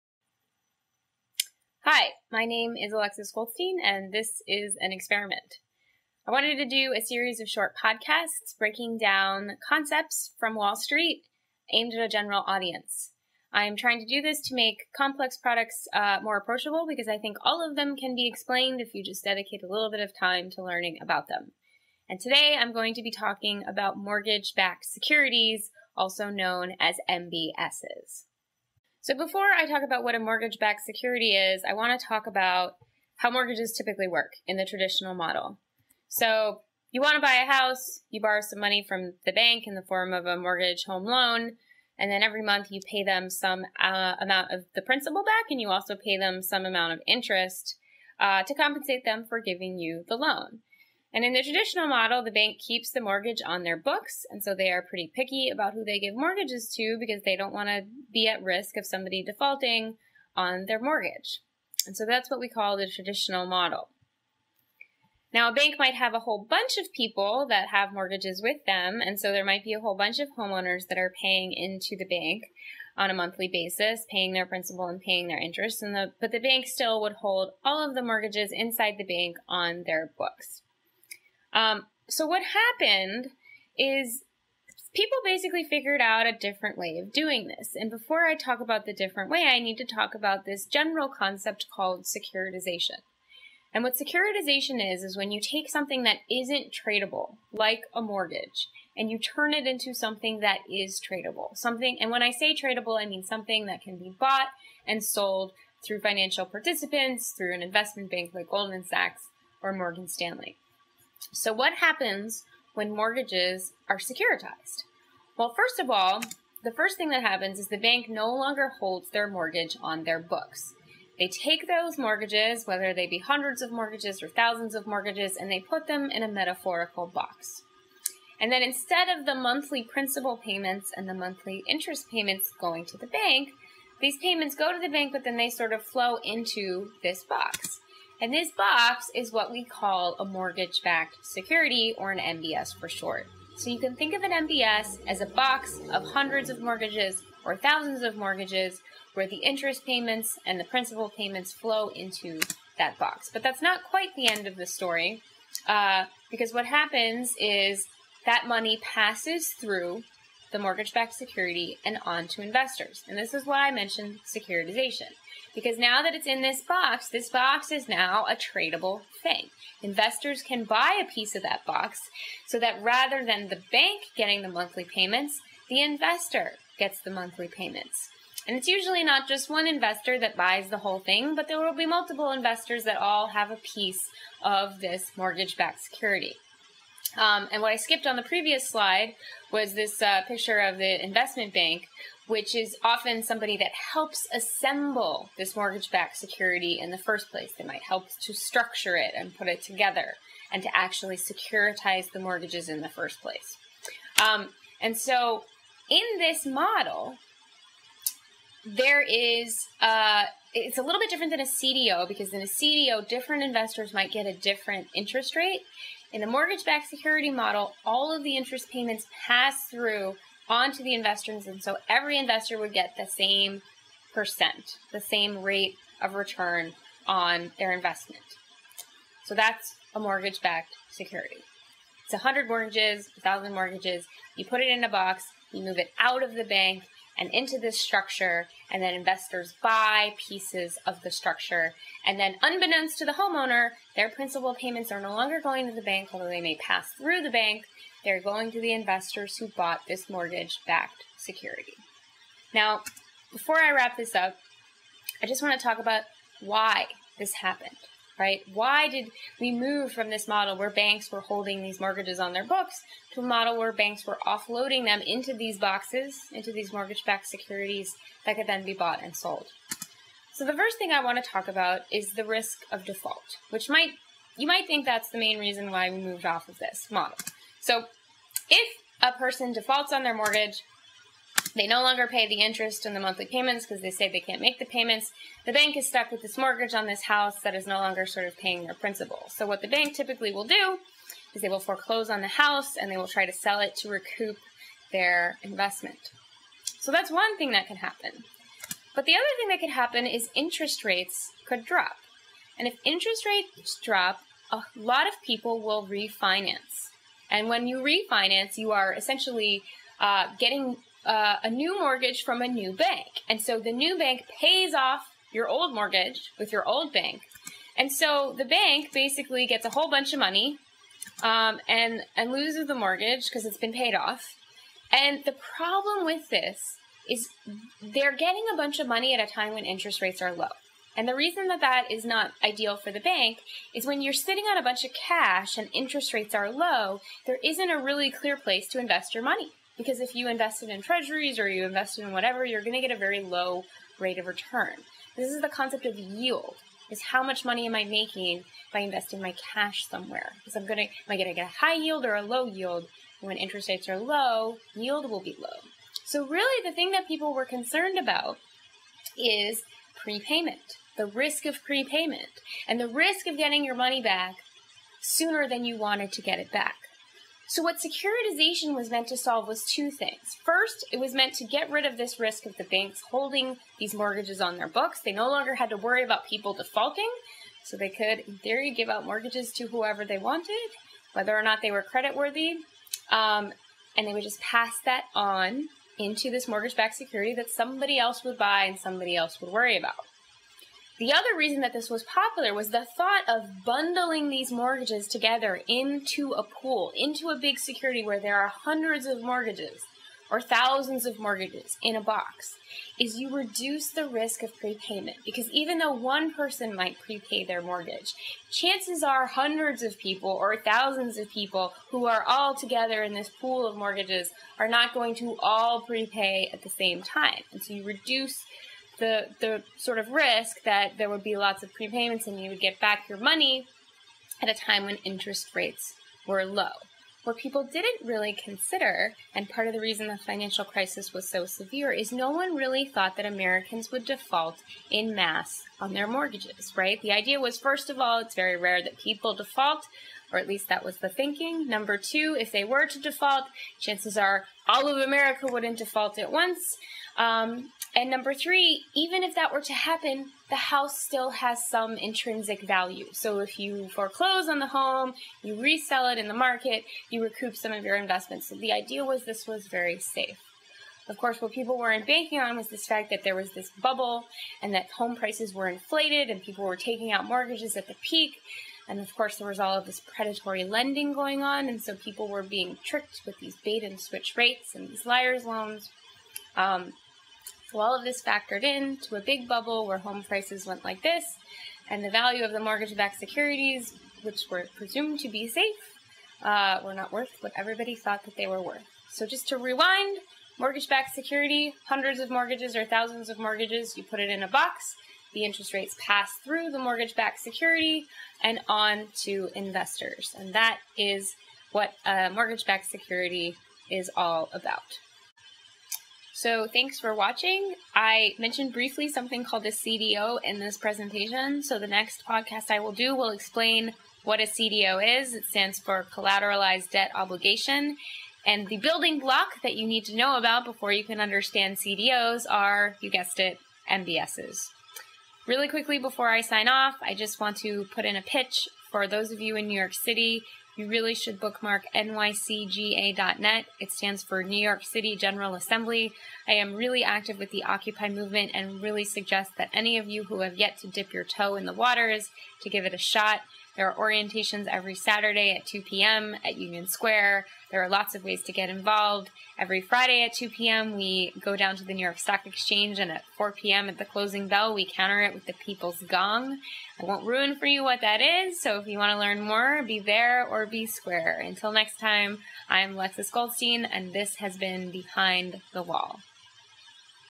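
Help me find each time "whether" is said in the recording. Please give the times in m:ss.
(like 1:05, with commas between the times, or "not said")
2:02, 6:21.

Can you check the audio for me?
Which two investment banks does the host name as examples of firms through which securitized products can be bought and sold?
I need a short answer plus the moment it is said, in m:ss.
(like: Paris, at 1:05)
Goldman Sachs or Morgan Stanley, at 1:48.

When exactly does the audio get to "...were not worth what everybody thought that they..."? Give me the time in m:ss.
8:06.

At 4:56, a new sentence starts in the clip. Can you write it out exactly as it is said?
So, that's one thing that can happen.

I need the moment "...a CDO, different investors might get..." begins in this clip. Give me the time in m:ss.
3:32.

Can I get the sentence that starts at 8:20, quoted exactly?
And that is what mortgage backed security is all about.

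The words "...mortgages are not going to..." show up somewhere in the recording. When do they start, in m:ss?
6:53.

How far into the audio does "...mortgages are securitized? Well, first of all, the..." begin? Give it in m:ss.
1:52.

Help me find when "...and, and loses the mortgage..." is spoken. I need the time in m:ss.
5:21.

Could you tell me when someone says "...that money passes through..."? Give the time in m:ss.
2:38.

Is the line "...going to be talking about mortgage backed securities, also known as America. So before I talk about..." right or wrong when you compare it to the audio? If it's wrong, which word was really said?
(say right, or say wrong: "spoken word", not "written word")
wrong: "MBSs", not "America".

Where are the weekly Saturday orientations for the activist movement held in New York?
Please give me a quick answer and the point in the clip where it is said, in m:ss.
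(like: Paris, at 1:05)
Union Square, at 9:06.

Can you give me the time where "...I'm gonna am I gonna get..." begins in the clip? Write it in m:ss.
5:50.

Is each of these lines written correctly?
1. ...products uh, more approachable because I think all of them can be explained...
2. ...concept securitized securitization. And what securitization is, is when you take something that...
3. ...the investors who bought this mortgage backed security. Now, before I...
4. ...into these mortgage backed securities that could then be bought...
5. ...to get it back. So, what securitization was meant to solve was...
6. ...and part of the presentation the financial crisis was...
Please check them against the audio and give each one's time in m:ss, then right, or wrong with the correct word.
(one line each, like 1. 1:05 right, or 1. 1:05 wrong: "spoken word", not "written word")
1. 0:15 right
2. 1:31 wrong: "called", not "securitized"
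3. 4:08 right
4. 4:26 right
5. 6:06 right
6. 7:09 wrong: "reason", not "presentation".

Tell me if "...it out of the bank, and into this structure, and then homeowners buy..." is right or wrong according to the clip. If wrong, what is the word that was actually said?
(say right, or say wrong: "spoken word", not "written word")
wrong: "investors", not "homeowners".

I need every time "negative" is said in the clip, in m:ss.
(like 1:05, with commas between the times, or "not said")
not said.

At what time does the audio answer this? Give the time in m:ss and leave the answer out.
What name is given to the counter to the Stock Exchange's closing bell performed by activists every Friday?
9:15.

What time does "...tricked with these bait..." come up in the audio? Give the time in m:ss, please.
7:52.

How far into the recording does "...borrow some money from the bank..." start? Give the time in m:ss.
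0:38.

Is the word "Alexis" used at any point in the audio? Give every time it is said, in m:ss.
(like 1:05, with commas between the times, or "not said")
0:02, 9:22.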